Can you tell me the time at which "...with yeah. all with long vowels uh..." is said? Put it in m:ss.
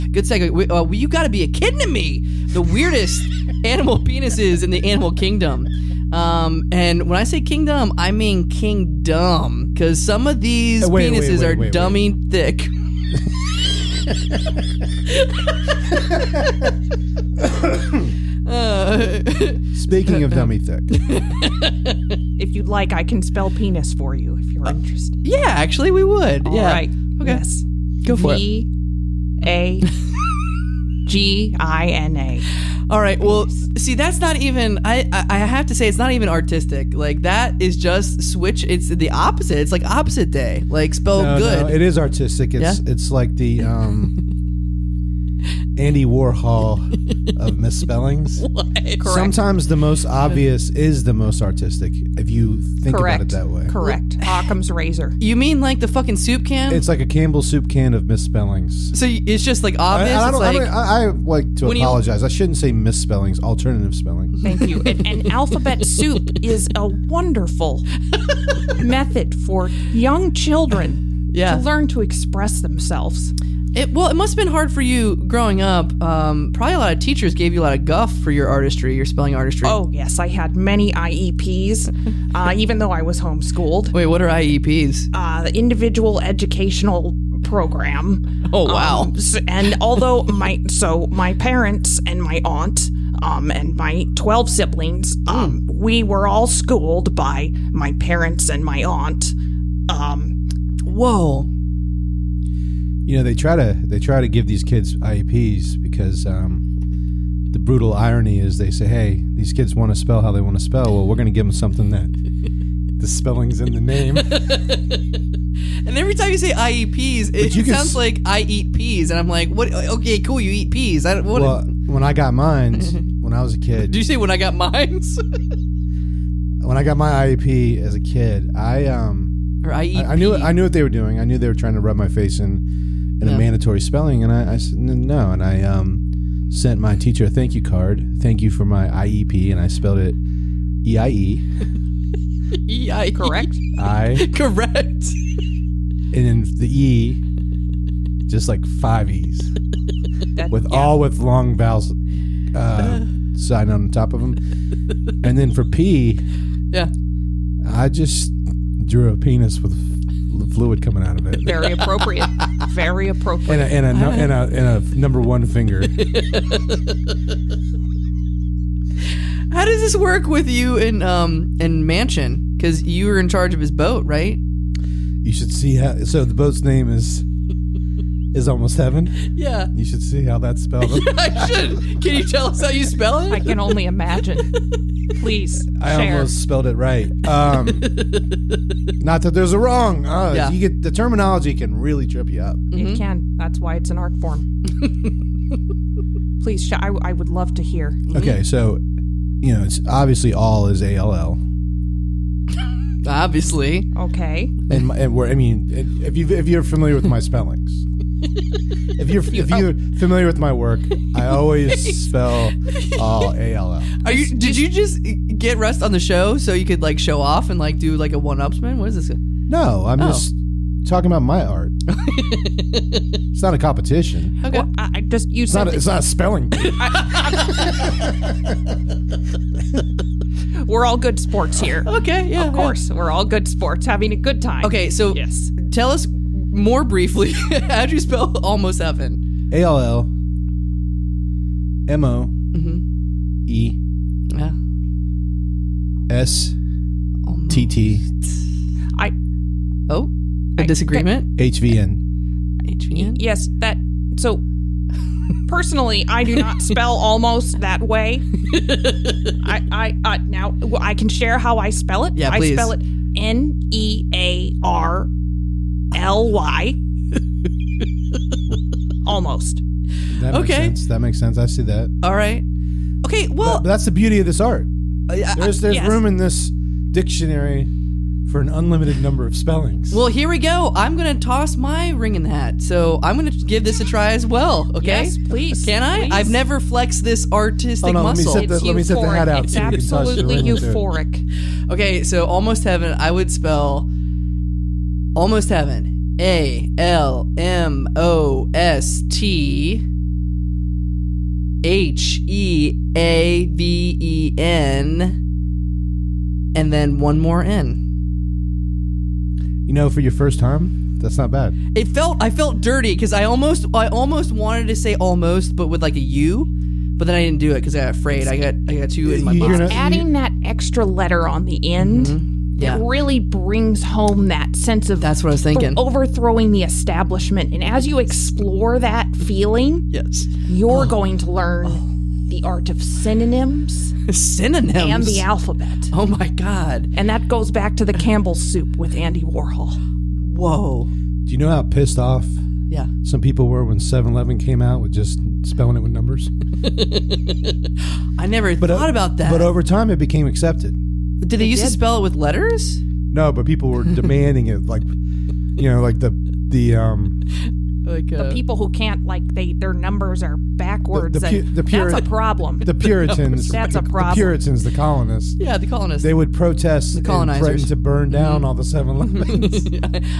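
2:30.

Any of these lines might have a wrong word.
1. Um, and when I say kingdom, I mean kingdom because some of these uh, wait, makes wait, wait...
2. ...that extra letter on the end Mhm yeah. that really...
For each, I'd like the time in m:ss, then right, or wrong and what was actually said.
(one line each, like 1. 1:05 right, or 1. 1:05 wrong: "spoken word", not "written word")
1. 0:06 wrong: "penises", not "makes"
2. 5:20 right.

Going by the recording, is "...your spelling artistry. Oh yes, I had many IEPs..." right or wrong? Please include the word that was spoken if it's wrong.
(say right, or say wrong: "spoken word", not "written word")
right.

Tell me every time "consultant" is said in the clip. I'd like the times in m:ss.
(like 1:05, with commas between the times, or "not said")
not said.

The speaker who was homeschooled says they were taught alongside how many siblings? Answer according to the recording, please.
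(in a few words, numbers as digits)
12.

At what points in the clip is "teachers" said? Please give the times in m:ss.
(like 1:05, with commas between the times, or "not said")
1:16, 2:16.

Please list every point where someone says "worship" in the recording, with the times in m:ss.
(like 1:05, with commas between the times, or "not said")
not said.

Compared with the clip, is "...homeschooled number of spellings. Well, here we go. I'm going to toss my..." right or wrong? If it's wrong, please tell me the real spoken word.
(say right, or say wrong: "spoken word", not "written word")
wrong: "unlimited", not "homeschooled".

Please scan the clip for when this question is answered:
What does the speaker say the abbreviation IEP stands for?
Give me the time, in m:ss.
1:25.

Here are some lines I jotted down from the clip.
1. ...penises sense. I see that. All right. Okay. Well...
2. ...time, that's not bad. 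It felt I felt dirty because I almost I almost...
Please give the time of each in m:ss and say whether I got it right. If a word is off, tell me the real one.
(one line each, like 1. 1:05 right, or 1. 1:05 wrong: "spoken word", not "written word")
1. 4:31 wrong: "makes", not "penises"
2. 5:10 right.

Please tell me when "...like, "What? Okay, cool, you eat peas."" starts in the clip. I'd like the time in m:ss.
1:59.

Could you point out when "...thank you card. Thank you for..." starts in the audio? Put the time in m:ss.
2:17.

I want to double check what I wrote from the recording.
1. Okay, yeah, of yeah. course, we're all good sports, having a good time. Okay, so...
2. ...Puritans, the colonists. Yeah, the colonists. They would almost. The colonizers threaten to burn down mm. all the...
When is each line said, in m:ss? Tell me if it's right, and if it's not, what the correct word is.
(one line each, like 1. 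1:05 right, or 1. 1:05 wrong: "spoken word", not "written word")
1. 3:51 right
2. 6:04 wrong: "protest", not "almost".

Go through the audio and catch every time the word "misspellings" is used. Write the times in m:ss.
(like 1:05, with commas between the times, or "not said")
0:47, 0:58, 1:02.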